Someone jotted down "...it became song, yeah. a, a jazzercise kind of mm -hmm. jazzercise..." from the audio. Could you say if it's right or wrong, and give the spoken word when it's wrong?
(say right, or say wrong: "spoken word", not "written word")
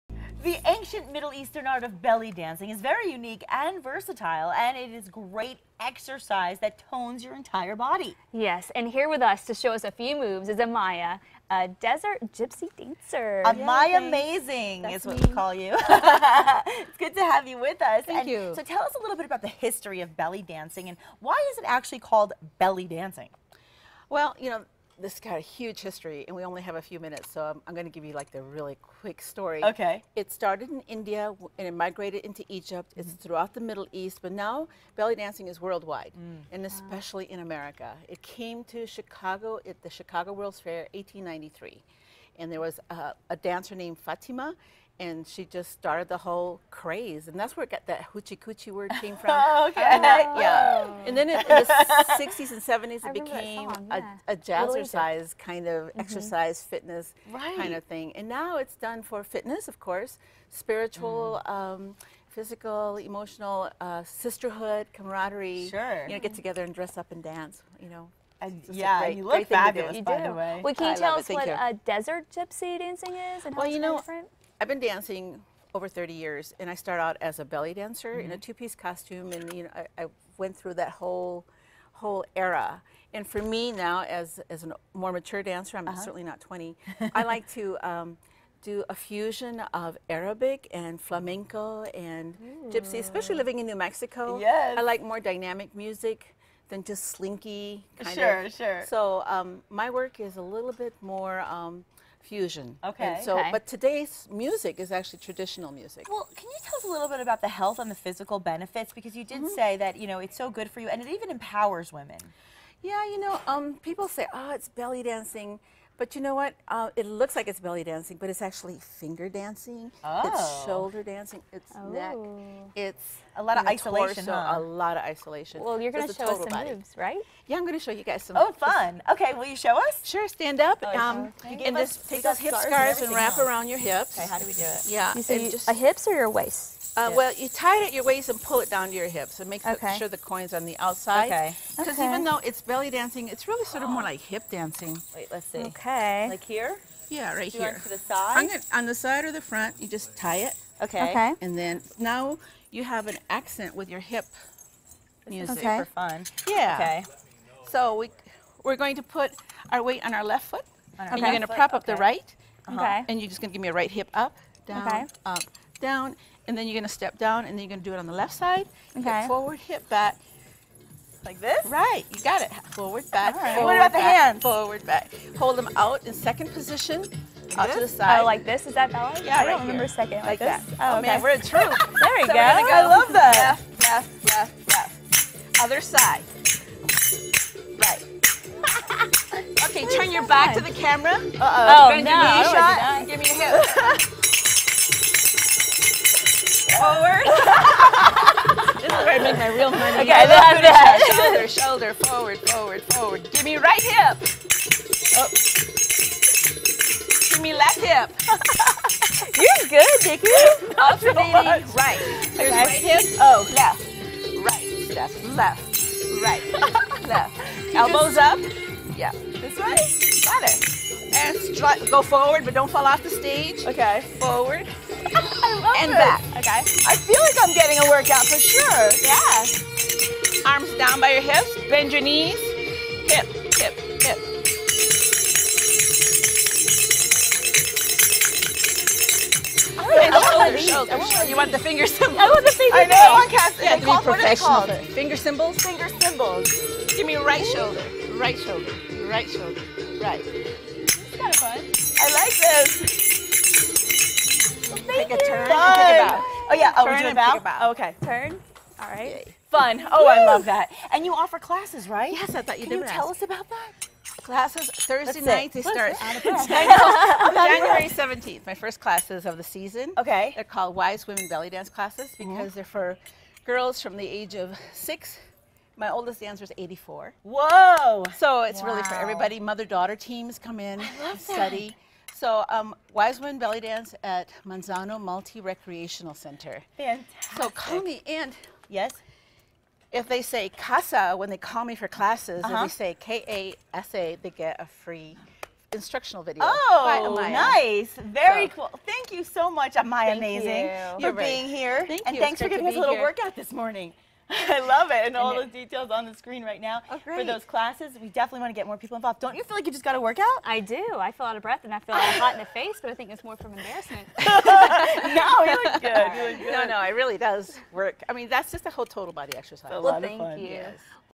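wrong: "exercise", not "jazzercise".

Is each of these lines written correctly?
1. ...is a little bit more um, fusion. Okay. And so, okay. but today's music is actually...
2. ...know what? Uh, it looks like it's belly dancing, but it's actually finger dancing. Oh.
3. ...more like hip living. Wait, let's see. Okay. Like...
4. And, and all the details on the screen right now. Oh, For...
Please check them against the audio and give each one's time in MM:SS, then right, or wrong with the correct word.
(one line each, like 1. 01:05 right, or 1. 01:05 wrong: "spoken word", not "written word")
1. 01:40 right
2. 01:56 right
3. 02:23 wrong: "dancing", not "living"
4. 05:04 right.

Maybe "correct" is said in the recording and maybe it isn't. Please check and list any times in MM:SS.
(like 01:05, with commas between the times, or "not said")
not said.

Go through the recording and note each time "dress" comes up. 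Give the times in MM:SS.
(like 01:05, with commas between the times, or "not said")
01:06.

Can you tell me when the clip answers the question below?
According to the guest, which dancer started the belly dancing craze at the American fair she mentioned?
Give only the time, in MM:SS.
00:44.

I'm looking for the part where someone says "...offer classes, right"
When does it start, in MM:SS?
04:21.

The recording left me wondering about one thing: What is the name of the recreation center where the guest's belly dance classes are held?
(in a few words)
Manzano Multi Recreational Center.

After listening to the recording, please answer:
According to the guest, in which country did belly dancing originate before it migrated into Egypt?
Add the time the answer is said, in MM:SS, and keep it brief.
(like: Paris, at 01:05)
India, at 00:30.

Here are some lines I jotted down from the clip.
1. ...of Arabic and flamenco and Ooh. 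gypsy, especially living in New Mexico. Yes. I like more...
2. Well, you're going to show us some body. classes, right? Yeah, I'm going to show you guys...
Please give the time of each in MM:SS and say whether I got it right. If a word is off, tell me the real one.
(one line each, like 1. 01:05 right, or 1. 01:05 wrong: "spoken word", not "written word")
1. 01:29 right
2. 02:05 wrong: "moves", not "classes".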